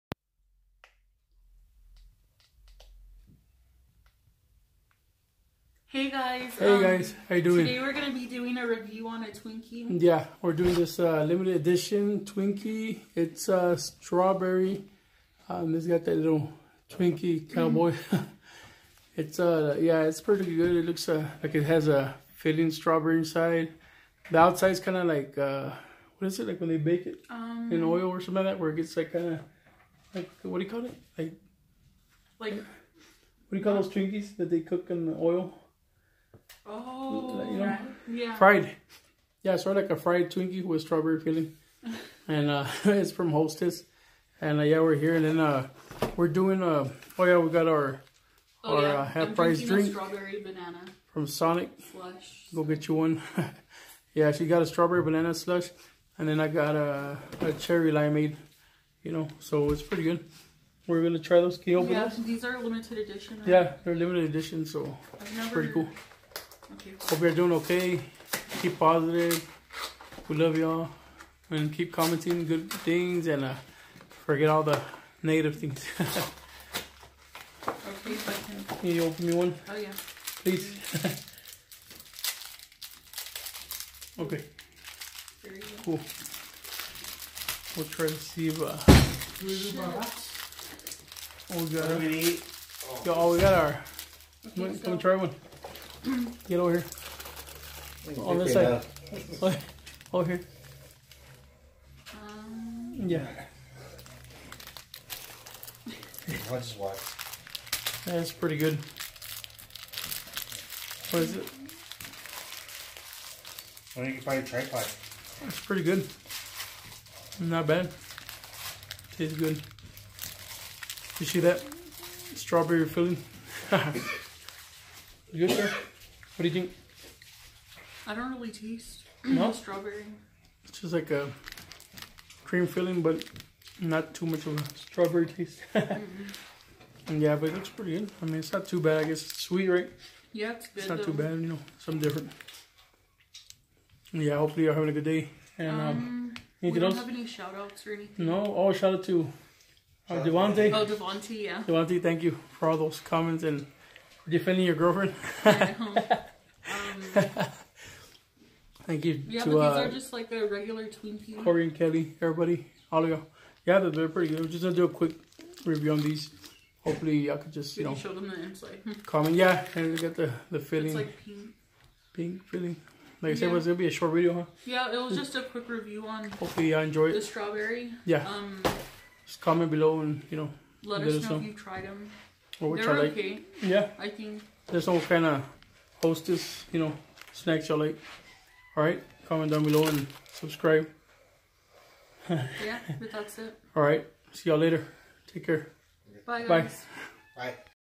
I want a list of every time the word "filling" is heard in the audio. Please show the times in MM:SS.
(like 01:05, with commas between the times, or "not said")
00:22, 00:41, 02:02, 02:12.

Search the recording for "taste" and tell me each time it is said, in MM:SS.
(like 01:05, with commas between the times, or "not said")
01:59, 02:08, 02:15.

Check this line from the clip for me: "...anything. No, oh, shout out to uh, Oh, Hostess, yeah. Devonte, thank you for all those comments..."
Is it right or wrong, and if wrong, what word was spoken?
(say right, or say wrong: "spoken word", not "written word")
wrong: "Devonte", not "Hostess".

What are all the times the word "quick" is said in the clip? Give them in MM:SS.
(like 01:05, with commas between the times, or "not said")
02:44, 02:55.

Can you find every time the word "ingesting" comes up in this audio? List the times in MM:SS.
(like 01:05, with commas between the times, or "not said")
not said.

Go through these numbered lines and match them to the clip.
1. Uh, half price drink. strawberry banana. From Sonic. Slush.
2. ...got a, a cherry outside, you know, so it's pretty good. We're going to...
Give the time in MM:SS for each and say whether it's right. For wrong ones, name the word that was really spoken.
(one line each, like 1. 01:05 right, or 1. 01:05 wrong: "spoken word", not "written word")
1. 00:48 right
2. 00:56 wrong: "limeade", not "outside".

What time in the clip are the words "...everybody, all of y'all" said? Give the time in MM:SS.
02:42.